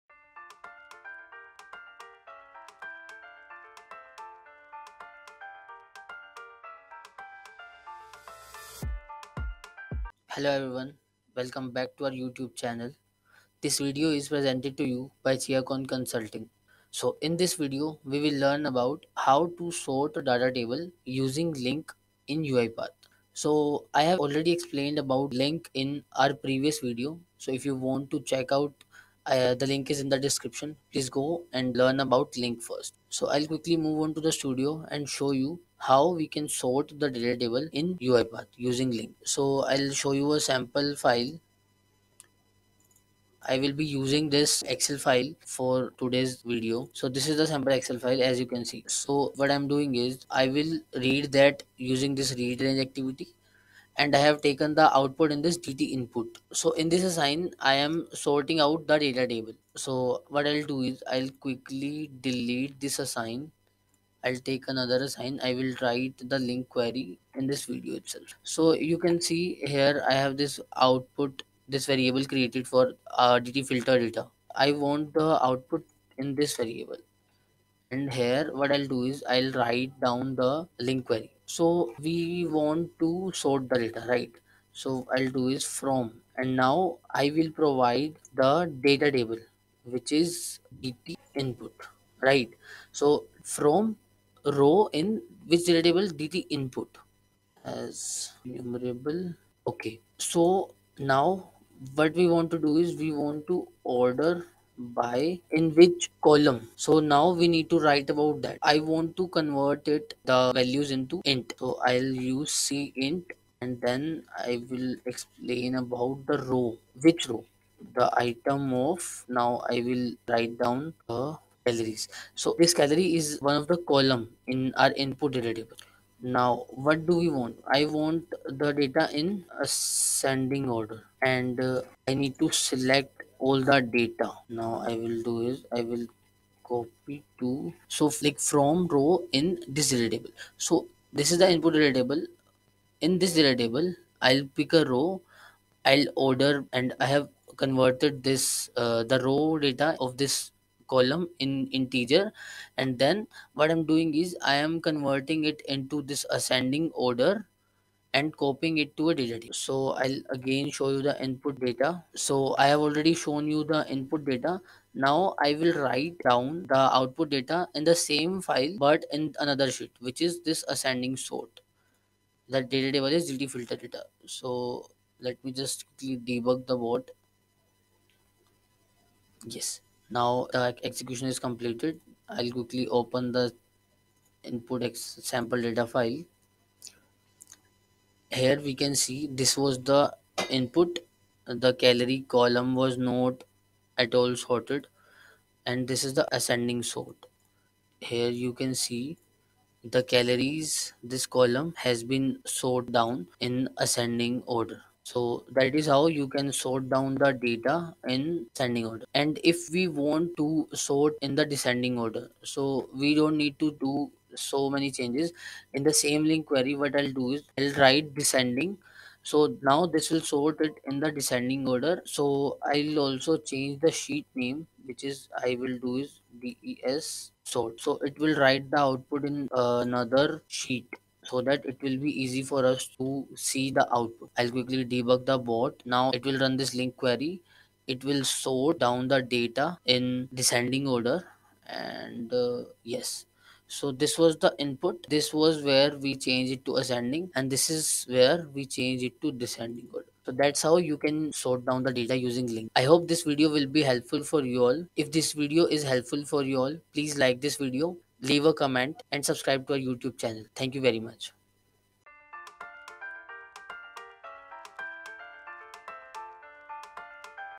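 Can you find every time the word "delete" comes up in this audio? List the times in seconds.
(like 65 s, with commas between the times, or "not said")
62 s.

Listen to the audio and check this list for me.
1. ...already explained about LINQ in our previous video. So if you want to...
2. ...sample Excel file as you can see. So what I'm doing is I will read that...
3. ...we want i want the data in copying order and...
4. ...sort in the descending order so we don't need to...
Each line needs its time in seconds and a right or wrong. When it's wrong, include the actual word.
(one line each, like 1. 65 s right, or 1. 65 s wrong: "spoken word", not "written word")
1. 24 s right
2. 47 s right
3. 127 s wrong: "ascending", not "copying"
4. 210 s right.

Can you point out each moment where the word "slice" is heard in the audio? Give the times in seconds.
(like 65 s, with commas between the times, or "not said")
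not said.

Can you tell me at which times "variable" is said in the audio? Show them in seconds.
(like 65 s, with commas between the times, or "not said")
71 s, 76 s.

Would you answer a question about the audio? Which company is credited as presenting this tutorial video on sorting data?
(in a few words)
Chiacon Consulting.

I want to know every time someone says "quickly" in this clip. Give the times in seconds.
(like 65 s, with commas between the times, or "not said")
33 s, 61 s, 175 s, 182 s, 234 s.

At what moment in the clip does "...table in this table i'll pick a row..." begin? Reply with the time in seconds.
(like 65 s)
141 s.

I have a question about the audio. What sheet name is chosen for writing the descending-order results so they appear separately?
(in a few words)
des sort.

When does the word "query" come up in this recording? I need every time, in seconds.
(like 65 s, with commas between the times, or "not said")
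66 s, 81 s, 216 s, 236 s.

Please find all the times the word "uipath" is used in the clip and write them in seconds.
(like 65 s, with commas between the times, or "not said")
22 s, 37 s.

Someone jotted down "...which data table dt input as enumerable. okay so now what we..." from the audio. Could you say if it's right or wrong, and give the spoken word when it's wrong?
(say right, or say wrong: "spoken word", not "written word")
right.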